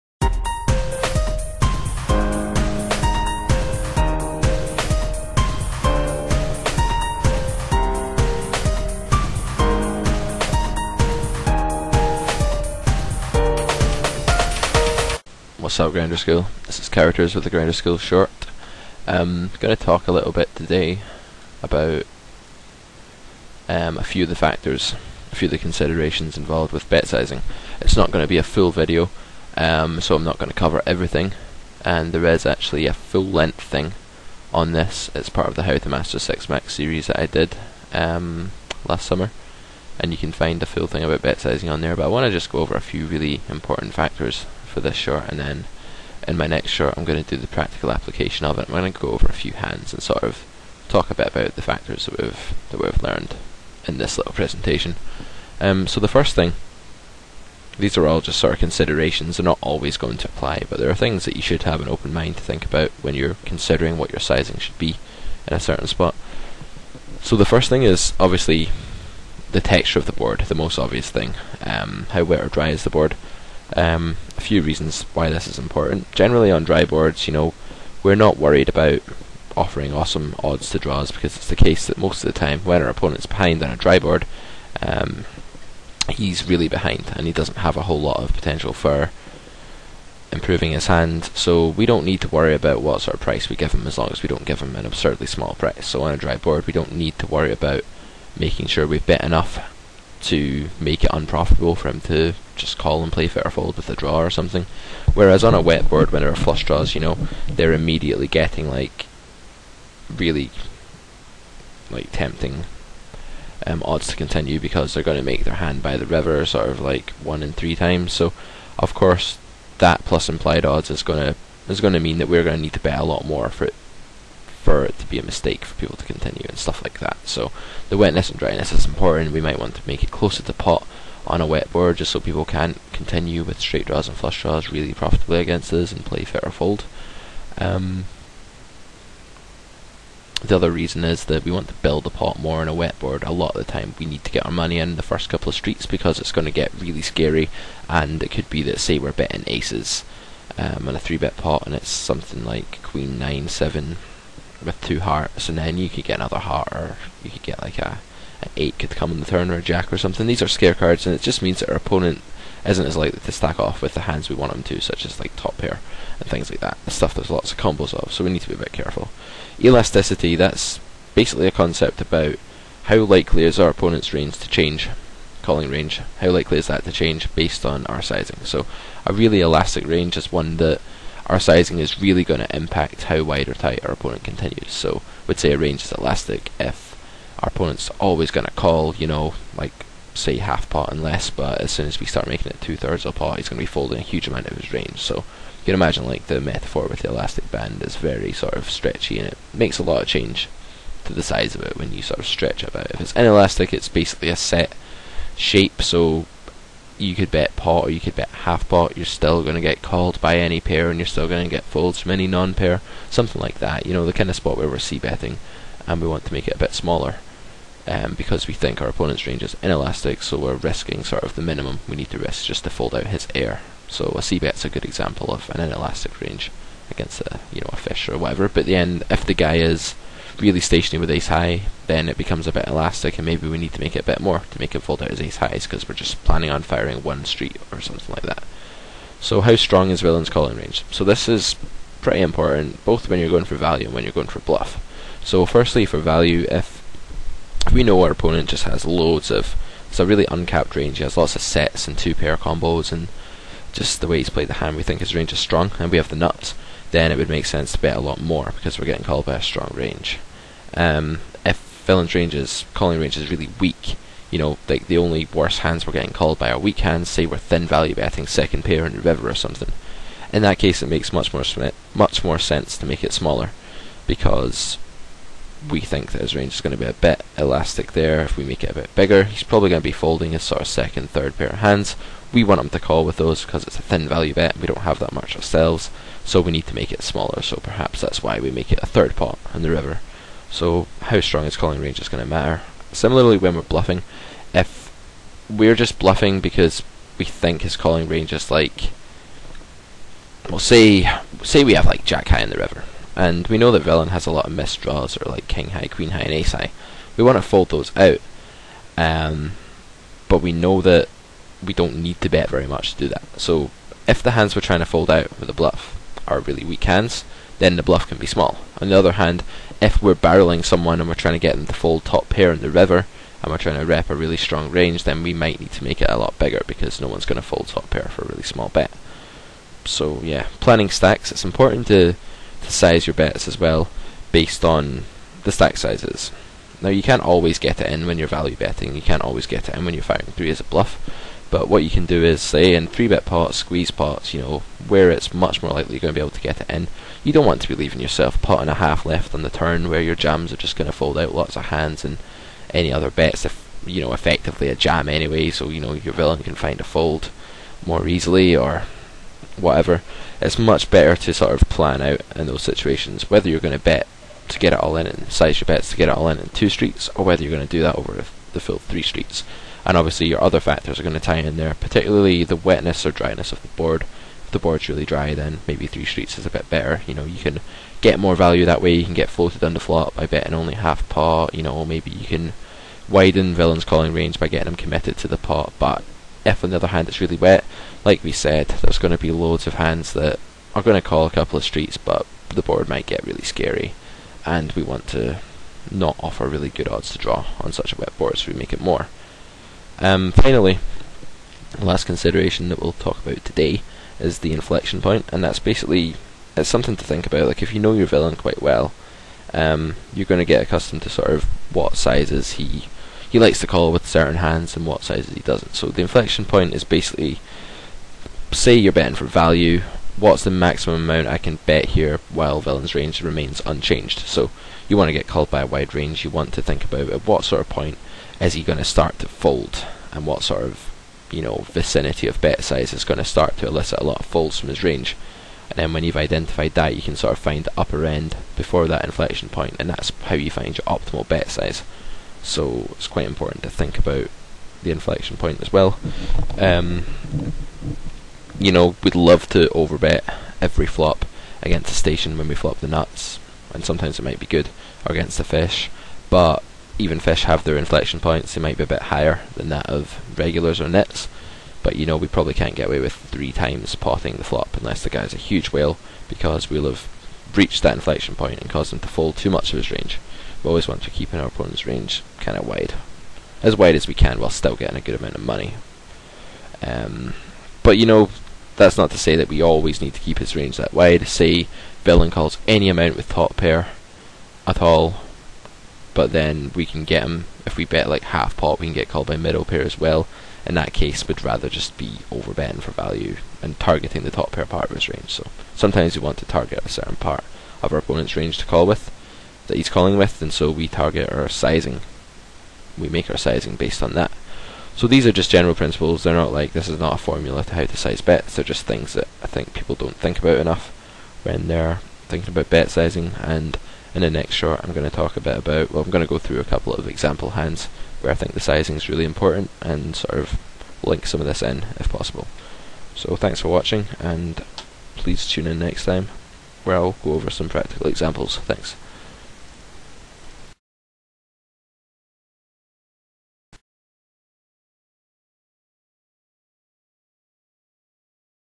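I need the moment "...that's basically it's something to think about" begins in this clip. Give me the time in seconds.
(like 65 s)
405 s.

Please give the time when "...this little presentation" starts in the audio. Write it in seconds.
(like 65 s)
53 s.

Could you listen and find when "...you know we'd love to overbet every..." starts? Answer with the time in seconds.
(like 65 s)
448 s.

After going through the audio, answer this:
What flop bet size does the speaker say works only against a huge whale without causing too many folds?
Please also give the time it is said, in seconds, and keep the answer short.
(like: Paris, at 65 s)
3 times pot, at 463 s.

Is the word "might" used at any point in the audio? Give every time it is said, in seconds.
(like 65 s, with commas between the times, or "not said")
129 s, 325 s, 392 s, 454 s, 458 s.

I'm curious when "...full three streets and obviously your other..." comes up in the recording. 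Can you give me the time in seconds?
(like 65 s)
368 s.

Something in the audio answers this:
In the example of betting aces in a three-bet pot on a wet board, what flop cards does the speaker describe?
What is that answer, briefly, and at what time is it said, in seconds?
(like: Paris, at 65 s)
Queen nine seven, at 152 s.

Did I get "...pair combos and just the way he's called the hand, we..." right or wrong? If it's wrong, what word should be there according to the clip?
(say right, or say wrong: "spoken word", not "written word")
wrong: "played", not "called".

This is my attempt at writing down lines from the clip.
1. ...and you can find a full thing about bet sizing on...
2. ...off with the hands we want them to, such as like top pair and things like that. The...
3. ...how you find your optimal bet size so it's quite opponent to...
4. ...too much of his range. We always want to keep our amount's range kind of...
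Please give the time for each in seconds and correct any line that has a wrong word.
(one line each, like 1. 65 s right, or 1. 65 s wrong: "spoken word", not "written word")
1. 39 s right
2. 163 s right
3. 440 s wrong: "important", not "opponent"
4. 469 s wrong: "opponent", not "amount".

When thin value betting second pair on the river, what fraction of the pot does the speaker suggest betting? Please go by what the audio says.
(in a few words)
A third pot.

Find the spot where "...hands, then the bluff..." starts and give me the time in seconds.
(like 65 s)
316 s.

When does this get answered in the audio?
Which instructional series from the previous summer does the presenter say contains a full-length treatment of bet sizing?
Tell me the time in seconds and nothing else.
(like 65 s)
35 s.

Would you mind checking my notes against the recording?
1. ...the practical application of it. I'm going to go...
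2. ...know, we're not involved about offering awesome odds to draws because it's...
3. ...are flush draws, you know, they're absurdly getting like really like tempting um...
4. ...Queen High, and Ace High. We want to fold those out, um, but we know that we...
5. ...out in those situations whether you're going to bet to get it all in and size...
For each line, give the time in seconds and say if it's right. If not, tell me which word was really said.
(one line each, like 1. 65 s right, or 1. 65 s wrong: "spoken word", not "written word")
1. 47 s right
2. 77 s wrong: "worried", not "involved"
3. 106 s wrong: "immediately", not "absurdly"
4. 305 s right
5. 362 s right.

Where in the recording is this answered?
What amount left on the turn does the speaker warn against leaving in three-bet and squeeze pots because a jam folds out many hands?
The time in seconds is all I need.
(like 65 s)
348 s.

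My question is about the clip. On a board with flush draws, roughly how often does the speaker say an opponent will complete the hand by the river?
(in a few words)
1 in 3.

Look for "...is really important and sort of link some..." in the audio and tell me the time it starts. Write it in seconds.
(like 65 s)
518 s.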